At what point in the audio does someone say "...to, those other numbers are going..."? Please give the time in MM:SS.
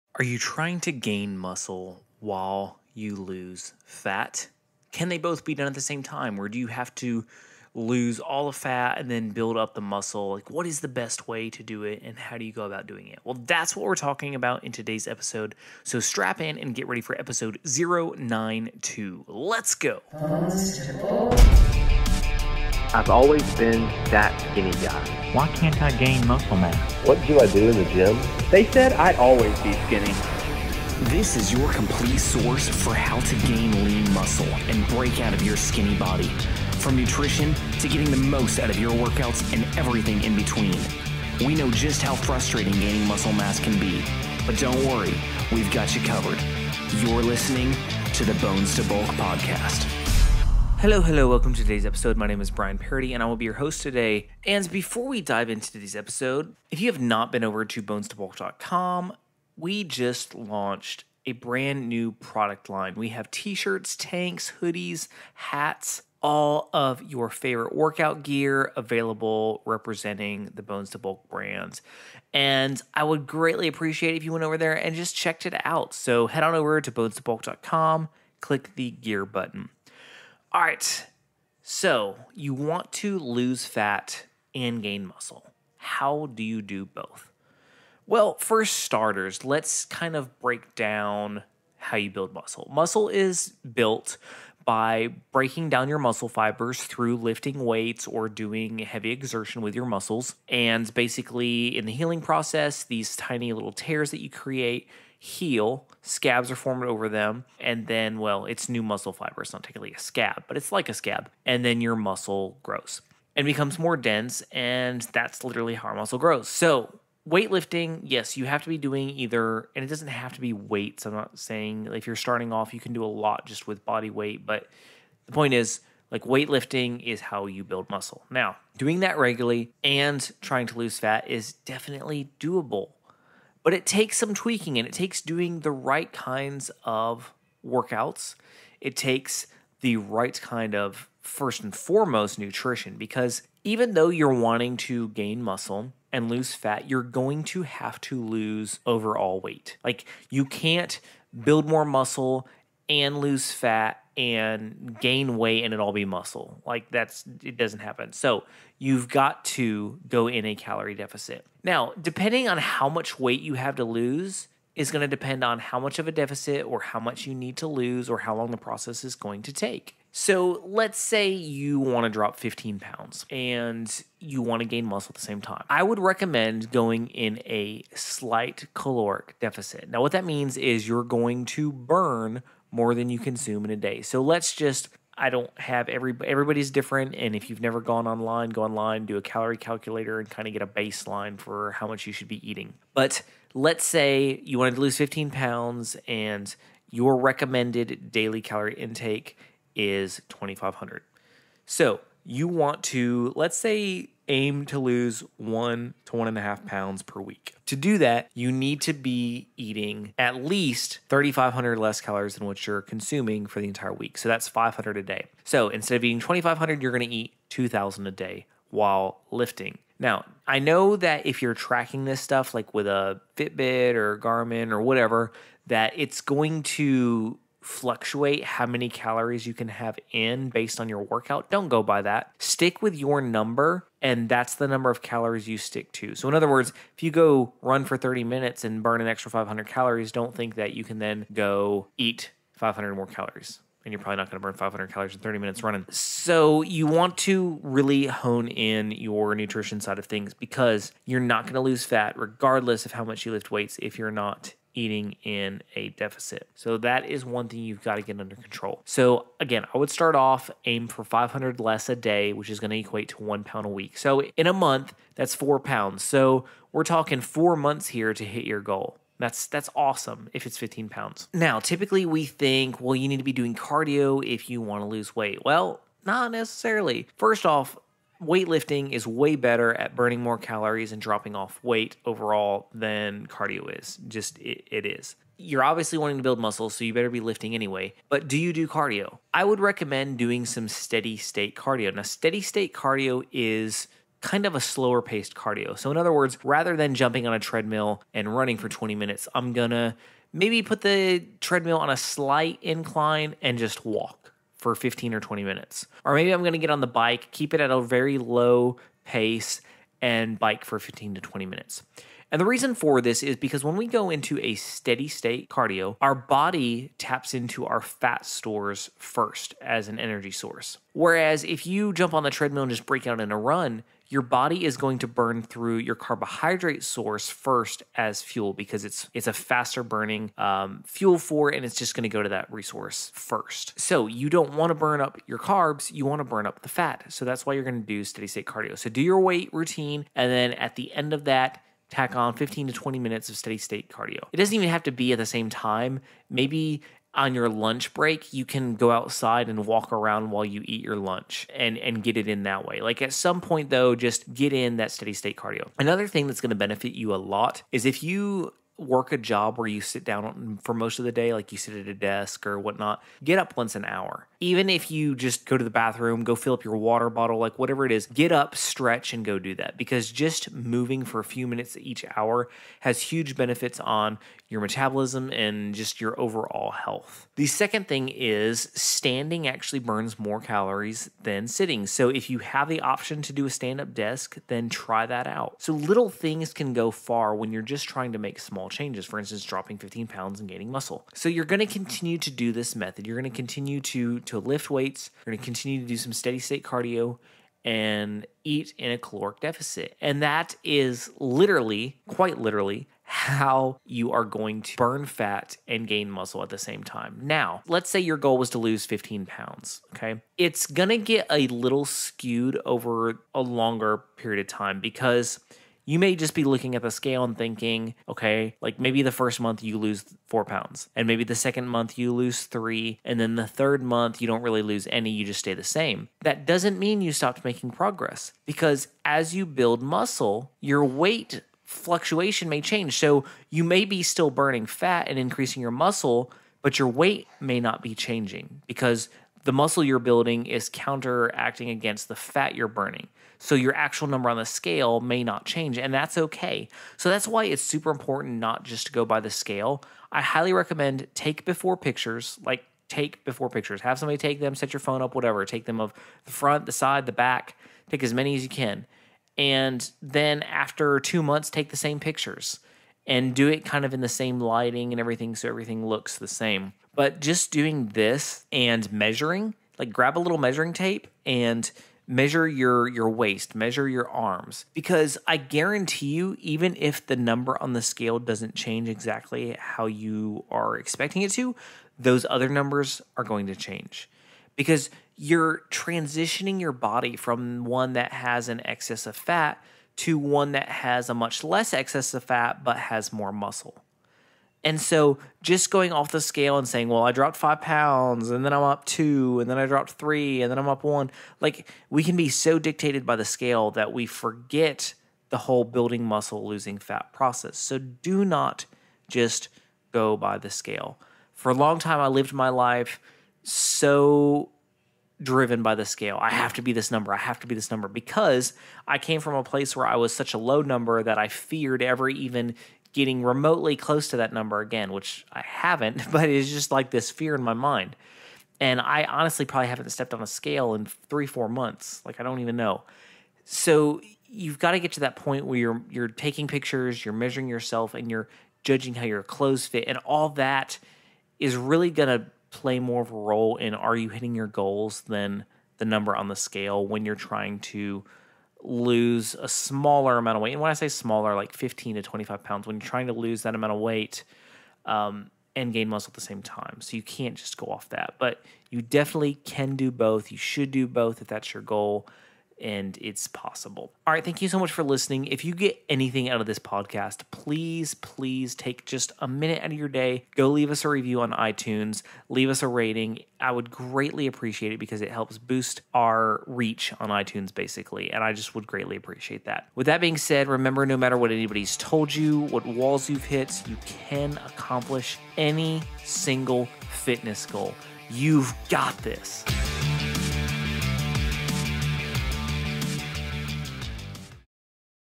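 08:01.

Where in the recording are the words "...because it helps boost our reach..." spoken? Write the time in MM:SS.
09:34.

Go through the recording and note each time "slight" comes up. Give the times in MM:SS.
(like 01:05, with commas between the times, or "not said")
02:57, 05:01.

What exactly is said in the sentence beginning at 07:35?
Take them of the front, the side, the back.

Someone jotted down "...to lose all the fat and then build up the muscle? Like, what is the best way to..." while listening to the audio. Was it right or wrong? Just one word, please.
right.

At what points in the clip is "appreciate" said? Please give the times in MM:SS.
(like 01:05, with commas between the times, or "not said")
01:13, 09:34, 09:38.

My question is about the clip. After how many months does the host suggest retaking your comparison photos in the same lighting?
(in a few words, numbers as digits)
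2 months.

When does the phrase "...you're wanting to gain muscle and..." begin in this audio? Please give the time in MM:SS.
02:24.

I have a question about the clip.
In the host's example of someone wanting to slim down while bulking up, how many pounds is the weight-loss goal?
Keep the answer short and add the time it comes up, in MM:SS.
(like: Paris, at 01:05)
15 pounds, at 02:52.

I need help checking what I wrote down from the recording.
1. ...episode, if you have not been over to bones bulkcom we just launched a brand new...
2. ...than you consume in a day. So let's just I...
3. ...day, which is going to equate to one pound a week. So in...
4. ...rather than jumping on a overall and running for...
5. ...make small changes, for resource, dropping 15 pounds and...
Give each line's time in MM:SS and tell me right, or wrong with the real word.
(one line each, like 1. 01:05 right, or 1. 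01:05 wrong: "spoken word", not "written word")
1. 00:55 right
2. 03:02 right
3. 04:21 right
4. 04:56 wrong: "treadmill", not "overall"
5. 06:28 wrong: "instance", not "resource".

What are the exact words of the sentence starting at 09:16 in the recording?
So you can't just go off that.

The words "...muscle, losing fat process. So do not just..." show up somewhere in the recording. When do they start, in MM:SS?
08:26.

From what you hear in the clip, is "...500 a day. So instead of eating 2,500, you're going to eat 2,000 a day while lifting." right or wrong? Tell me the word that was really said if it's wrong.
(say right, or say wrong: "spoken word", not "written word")
right.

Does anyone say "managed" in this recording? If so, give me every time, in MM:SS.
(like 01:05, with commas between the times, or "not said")
not said.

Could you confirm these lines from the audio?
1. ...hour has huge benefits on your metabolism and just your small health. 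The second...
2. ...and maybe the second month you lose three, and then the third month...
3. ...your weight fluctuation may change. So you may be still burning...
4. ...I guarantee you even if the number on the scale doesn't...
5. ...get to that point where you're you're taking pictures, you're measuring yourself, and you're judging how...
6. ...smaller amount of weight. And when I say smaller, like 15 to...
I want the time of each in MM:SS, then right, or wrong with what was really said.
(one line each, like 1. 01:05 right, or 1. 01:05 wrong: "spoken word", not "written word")
1. 06:12 wrong: "overall", not "small"
2. 07:00 right
3. 07:10 right
4. 07:55 right
5. 08:54 right
6. 09:09 right.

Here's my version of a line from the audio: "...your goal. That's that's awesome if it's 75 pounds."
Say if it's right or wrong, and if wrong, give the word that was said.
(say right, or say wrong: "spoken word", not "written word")
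wrong: "15", not "75".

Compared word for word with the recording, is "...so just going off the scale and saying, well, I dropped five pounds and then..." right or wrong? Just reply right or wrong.
right.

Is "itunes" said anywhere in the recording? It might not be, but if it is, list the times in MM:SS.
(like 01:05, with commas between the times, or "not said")
09:31, 09:37.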